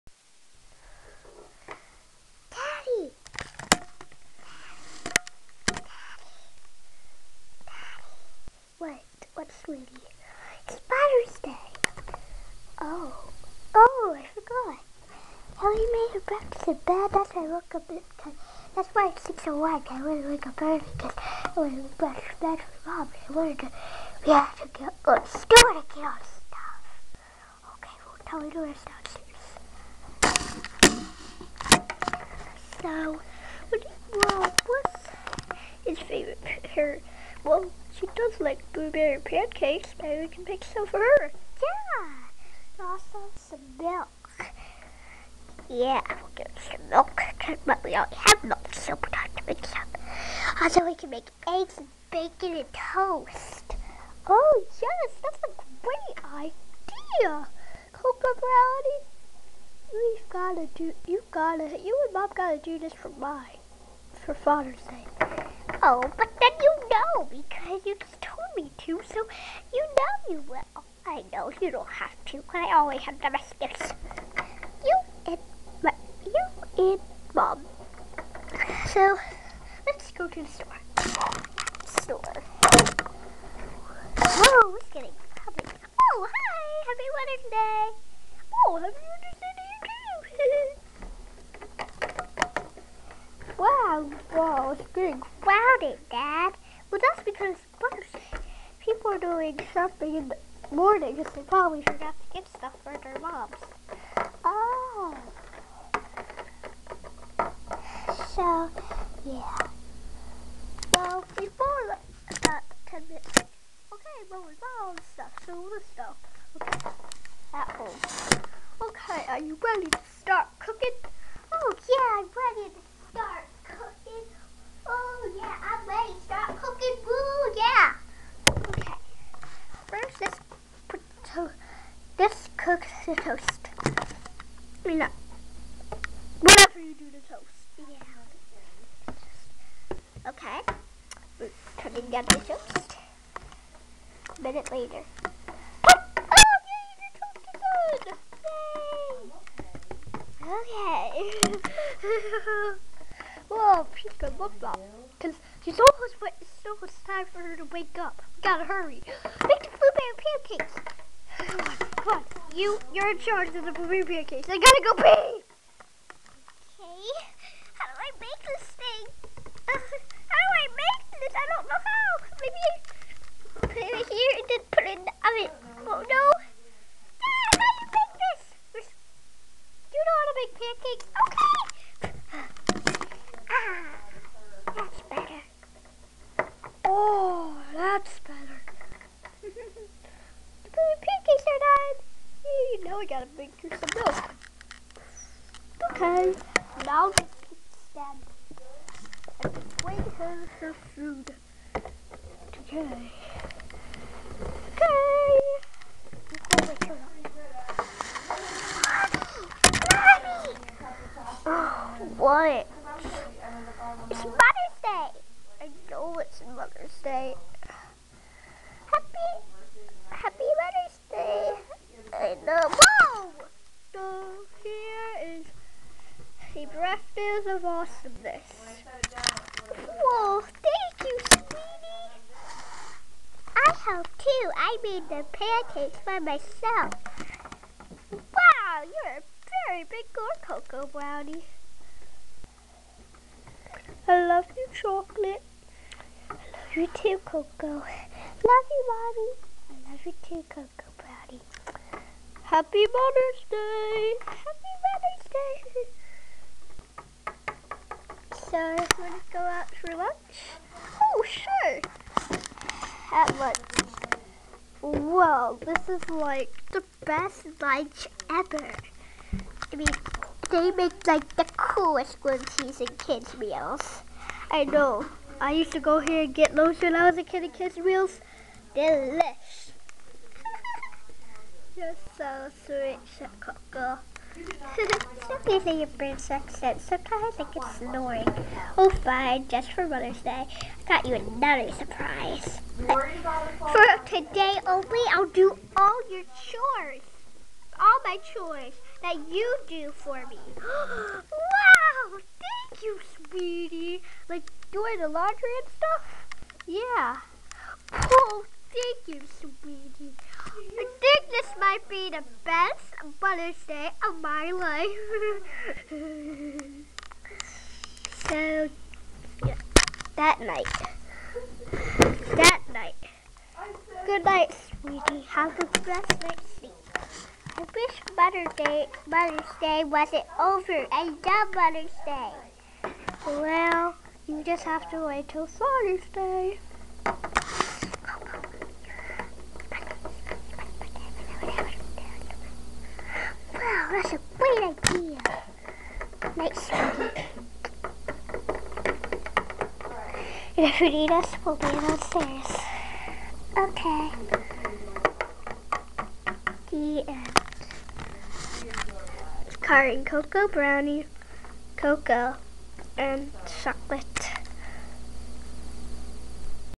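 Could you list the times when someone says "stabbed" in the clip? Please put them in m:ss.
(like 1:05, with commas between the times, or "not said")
3:17.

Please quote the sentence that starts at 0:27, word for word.
Okay, well, tell me to rest downstairs.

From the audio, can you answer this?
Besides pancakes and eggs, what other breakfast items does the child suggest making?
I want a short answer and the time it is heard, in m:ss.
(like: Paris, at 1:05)
Bacon and toast, at 0:52.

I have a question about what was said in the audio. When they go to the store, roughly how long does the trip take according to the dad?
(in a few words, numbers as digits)
10 minutes.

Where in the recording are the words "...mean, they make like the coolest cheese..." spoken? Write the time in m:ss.
4:29.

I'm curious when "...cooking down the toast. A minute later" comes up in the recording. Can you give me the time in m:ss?
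2:21.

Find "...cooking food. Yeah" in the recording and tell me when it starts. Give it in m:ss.
2:06.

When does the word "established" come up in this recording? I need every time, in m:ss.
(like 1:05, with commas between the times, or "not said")
not said.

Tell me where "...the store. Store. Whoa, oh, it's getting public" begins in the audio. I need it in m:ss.
1:20.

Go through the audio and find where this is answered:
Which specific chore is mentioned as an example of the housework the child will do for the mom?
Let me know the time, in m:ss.
5:04.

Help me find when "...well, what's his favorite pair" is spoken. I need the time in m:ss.
0:34.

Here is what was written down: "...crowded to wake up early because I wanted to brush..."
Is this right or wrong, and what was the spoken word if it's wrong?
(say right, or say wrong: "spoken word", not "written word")
wrong: "wanted", not "crowded".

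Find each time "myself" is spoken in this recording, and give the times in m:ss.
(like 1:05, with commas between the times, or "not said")
3:56.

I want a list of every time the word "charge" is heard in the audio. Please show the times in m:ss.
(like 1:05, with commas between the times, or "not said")
2:43.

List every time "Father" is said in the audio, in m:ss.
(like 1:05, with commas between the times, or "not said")
0:10, 1:04, 5:35.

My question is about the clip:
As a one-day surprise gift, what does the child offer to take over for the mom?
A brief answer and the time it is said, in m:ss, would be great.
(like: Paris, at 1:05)
All your chores, at 4:55.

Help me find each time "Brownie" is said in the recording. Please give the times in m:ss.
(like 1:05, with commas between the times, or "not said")
0:58, 4:00, 4:10, 6:00.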